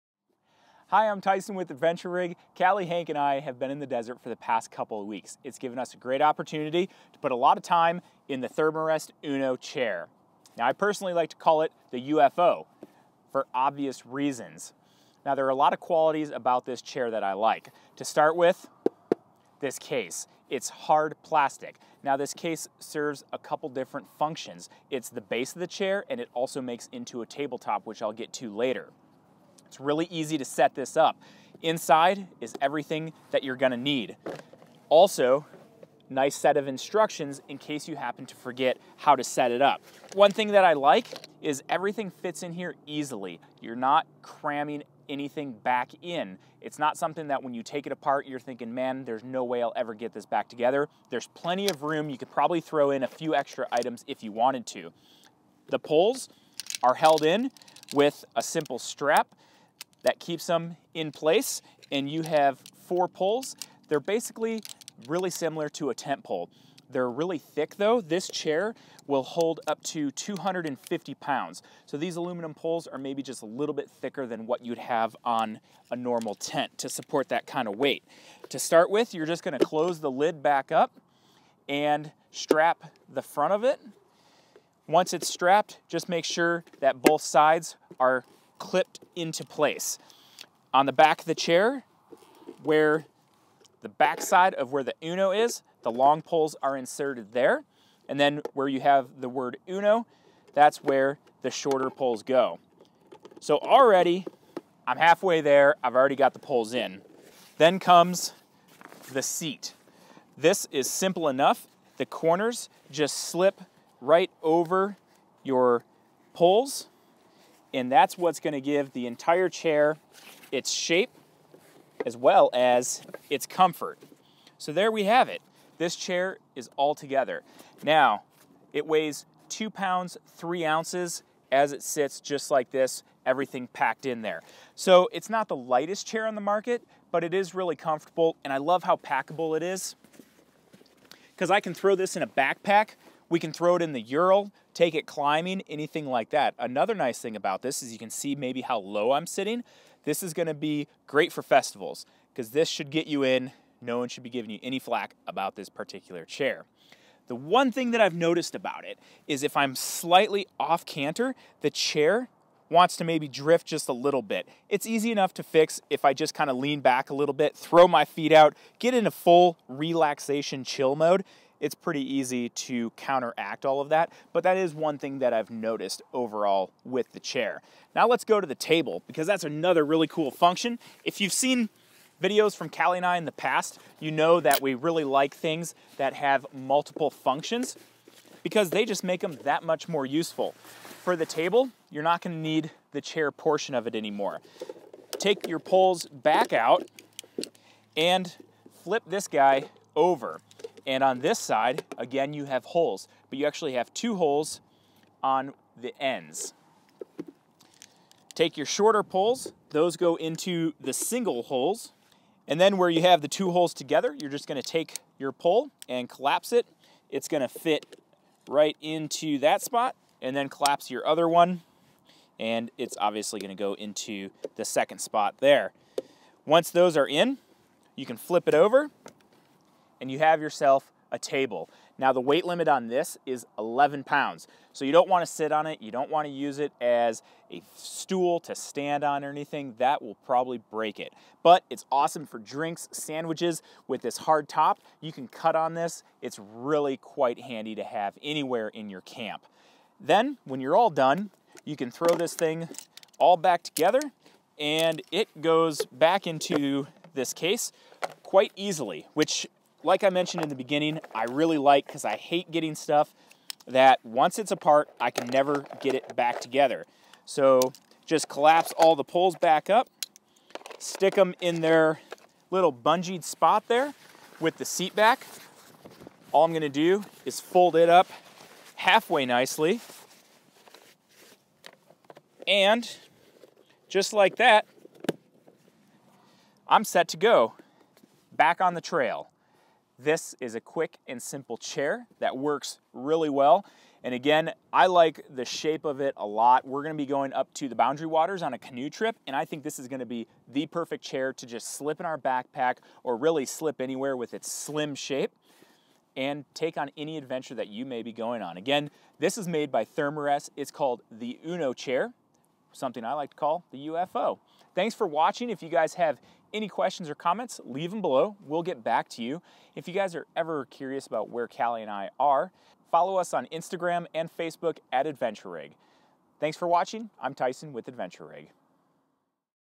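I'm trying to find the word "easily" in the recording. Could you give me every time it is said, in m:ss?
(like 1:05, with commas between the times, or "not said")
0:42, 4:18.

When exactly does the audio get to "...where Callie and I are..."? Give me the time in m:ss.
5:21.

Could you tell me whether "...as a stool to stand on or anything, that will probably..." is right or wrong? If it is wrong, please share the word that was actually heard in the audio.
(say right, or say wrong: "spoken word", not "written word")
right.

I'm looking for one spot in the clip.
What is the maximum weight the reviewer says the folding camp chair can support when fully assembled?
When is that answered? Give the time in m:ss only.
1:10.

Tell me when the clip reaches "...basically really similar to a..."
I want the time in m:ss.
1:03.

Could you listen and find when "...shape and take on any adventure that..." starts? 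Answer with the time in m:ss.
5:04.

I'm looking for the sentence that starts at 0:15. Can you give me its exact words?
Now, there are a lot of qualities about this chair that I like.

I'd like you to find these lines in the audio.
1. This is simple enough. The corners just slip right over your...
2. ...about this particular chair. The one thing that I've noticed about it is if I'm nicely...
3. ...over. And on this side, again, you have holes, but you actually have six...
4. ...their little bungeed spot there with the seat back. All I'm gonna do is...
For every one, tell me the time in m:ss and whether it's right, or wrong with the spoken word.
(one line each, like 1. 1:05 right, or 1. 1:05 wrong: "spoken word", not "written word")
1. 1:50 right
2. 2:35 wrong: "slightly", not "nicely"
3. 3:19 wrong: "two", not "six"
4. 4:31 right.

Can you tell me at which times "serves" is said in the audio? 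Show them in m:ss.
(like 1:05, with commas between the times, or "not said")
0:22.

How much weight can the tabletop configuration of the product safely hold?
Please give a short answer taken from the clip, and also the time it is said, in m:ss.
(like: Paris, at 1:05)
11 pounds, at 3:53.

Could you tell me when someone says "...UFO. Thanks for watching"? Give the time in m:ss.
5:13.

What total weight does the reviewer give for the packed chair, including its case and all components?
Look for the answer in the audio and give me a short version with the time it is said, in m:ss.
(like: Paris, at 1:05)
2 pounds, 3 ounces, at 2:09.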